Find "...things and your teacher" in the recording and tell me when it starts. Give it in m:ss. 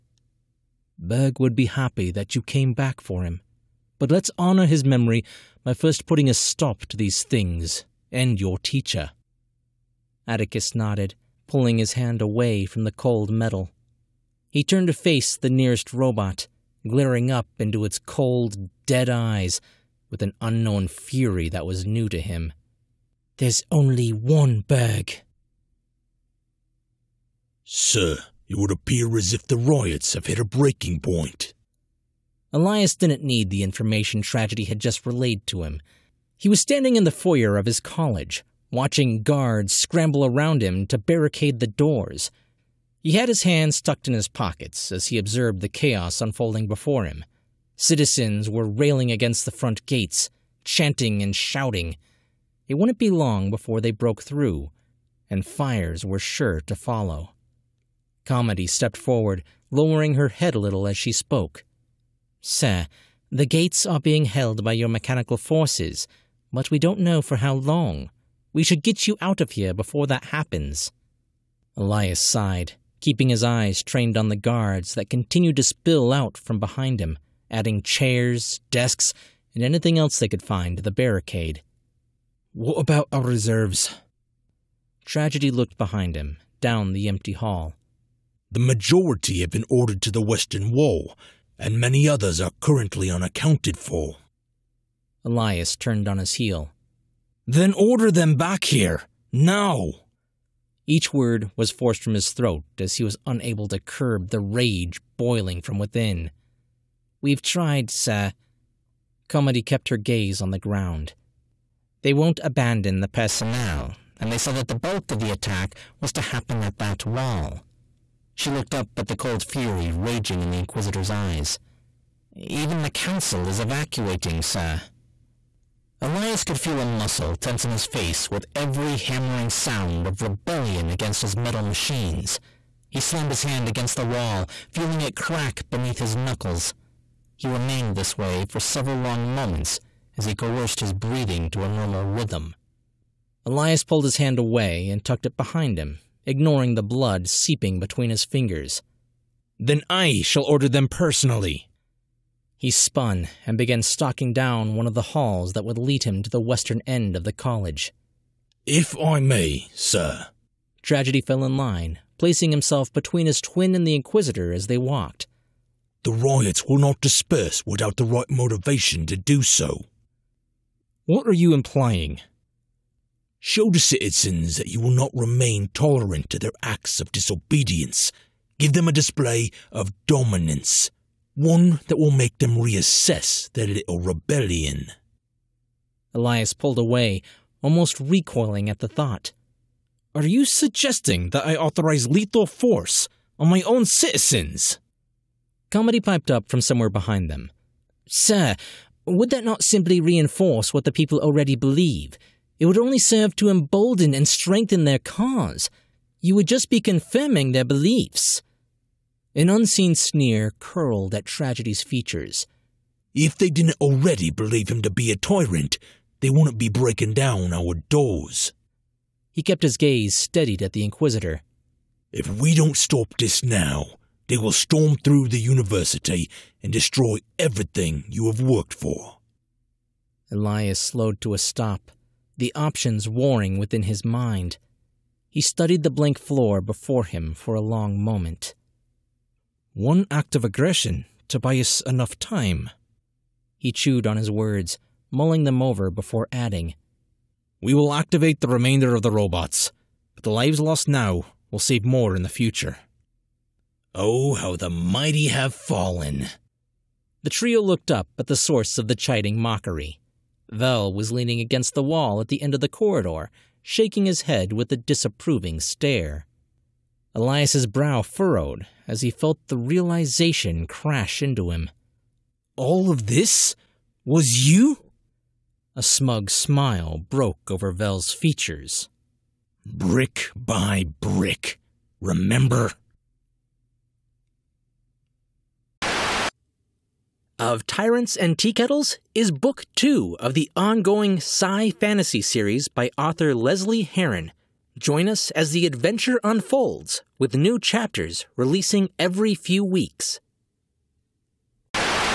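0:07.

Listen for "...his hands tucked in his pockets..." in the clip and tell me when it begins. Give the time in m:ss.
0:43.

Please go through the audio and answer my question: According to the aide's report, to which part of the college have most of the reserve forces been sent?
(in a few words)
Western wall.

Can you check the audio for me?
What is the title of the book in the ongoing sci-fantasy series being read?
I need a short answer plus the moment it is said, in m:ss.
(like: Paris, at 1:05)
Of Tyrants and Teakettles, at 4:47.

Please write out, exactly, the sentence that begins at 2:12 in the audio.
He slammed his hand against the wall, feeling it crack beneath his knuckles.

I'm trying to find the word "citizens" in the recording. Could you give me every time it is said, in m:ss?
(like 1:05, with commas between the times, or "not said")
0:47, 2:53, 3:13.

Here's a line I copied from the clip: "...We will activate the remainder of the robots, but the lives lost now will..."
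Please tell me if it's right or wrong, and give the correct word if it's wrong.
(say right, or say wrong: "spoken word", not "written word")
right.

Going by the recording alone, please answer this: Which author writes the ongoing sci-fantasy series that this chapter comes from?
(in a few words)
Lesley Herron.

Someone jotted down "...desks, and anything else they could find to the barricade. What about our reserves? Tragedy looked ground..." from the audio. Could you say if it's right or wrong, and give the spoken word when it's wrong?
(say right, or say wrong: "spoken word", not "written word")
wrong: "behind", not "ground".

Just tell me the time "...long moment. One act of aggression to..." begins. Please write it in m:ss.
3:57.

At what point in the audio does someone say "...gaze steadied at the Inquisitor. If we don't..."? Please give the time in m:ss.
3:39.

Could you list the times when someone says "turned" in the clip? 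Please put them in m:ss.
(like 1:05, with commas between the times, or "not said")
0:14, 1:35.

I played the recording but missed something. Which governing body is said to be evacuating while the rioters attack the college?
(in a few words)
The Council.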